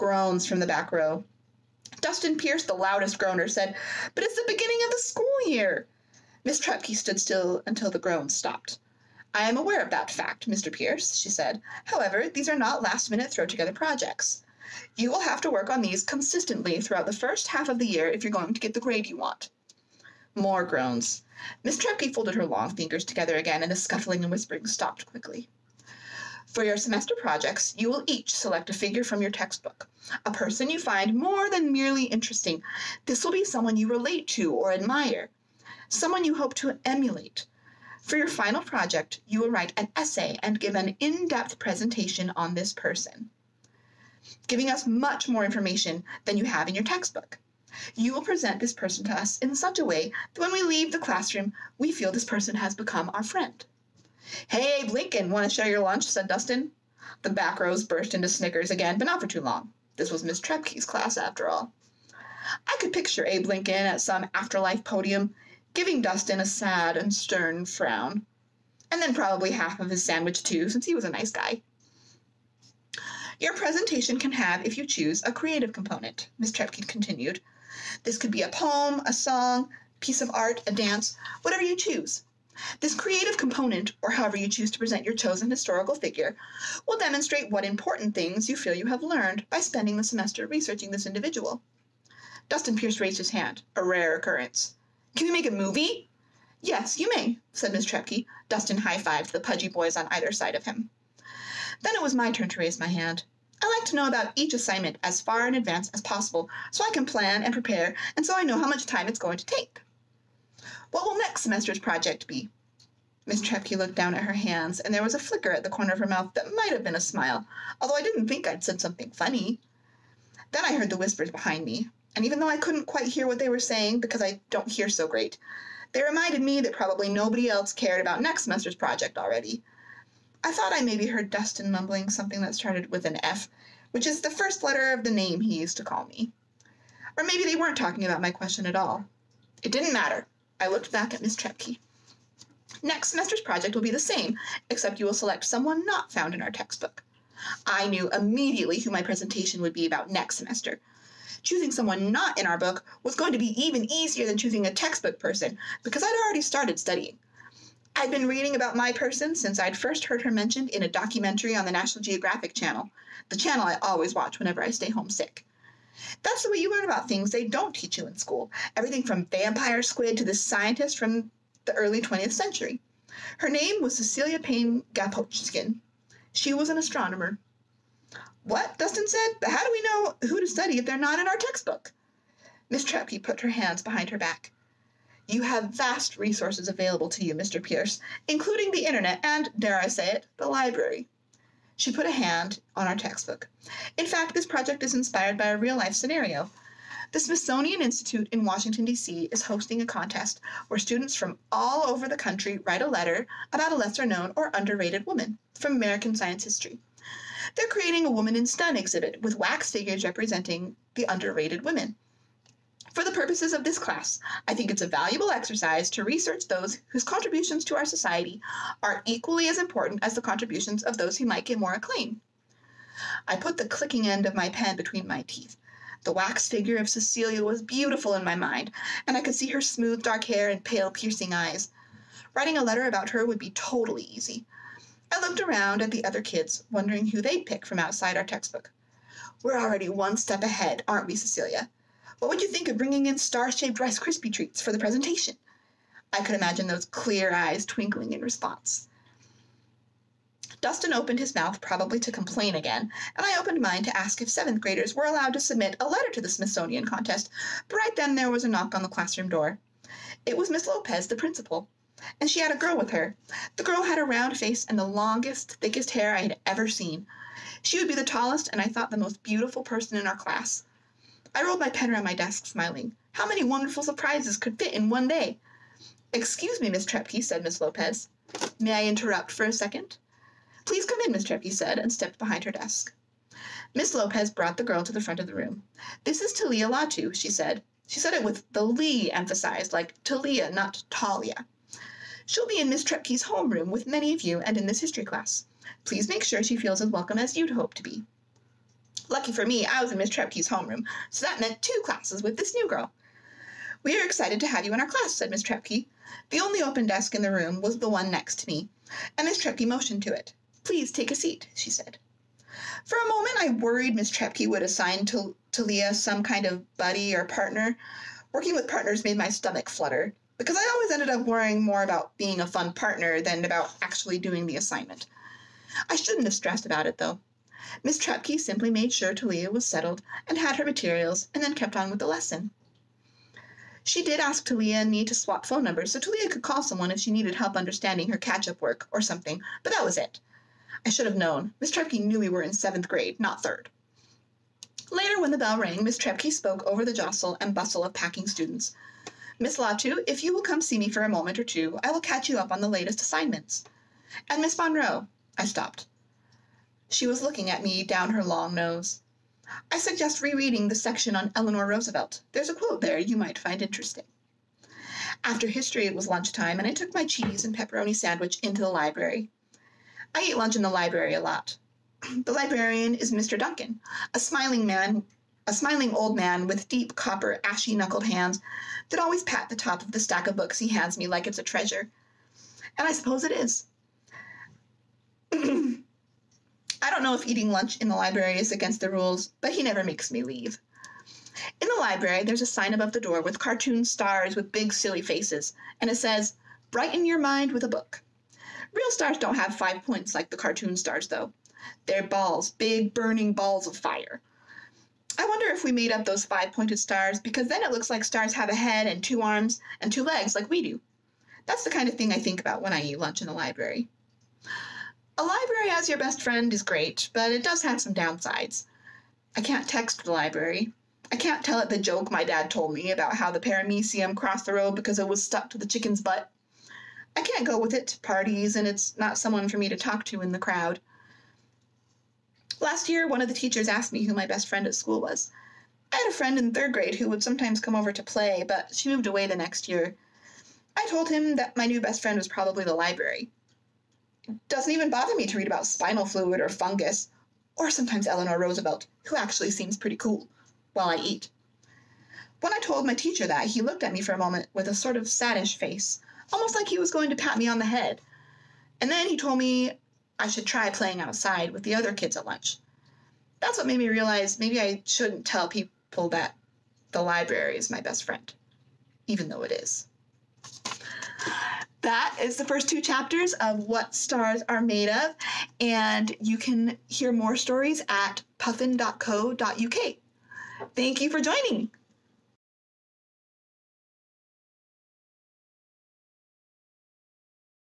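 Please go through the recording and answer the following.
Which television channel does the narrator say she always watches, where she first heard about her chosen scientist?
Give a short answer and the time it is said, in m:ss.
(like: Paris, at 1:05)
National Geographic Channel, at 2:41.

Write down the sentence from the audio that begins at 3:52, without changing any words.
Writing a letter about her would be totally easy.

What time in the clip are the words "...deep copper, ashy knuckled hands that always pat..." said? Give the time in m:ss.
6:16.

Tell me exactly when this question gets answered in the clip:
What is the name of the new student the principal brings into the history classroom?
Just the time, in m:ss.
4:46.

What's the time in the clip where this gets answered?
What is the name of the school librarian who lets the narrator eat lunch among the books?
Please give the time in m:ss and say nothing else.
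6:13.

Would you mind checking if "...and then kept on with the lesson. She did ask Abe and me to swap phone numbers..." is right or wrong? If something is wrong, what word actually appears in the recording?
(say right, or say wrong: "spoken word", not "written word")
wrong: "Talia", not "Abe".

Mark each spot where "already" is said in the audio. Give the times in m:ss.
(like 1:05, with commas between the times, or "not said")
2:09, 2:36, 3:59.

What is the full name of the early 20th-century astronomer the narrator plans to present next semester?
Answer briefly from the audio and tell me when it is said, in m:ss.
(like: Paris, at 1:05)
Cecilia Payne Gaposchkin, at 2:53.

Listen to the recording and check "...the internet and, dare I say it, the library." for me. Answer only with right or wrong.
right.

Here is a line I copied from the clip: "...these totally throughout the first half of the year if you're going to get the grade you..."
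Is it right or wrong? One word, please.
wrong.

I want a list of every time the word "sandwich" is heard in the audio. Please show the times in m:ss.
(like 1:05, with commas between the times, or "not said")
1:10, 6:07.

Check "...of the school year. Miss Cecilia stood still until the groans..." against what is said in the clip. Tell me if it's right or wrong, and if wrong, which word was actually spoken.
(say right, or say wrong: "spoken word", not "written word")
wrong: "Trepke", not "Cecilia".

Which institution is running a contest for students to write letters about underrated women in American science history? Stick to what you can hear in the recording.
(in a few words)
Smithsonian Institute.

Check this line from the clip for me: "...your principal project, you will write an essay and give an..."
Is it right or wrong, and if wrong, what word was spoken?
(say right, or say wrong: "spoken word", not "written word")
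wrong: "final", not "principal".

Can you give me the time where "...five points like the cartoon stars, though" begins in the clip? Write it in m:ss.
6:39.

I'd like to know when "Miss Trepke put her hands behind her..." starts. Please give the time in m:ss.
3:02.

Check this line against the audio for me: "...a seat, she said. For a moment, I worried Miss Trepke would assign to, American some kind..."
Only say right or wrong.
wrong.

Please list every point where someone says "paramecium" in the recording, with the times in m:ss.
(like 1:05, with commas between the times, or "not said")
7:03.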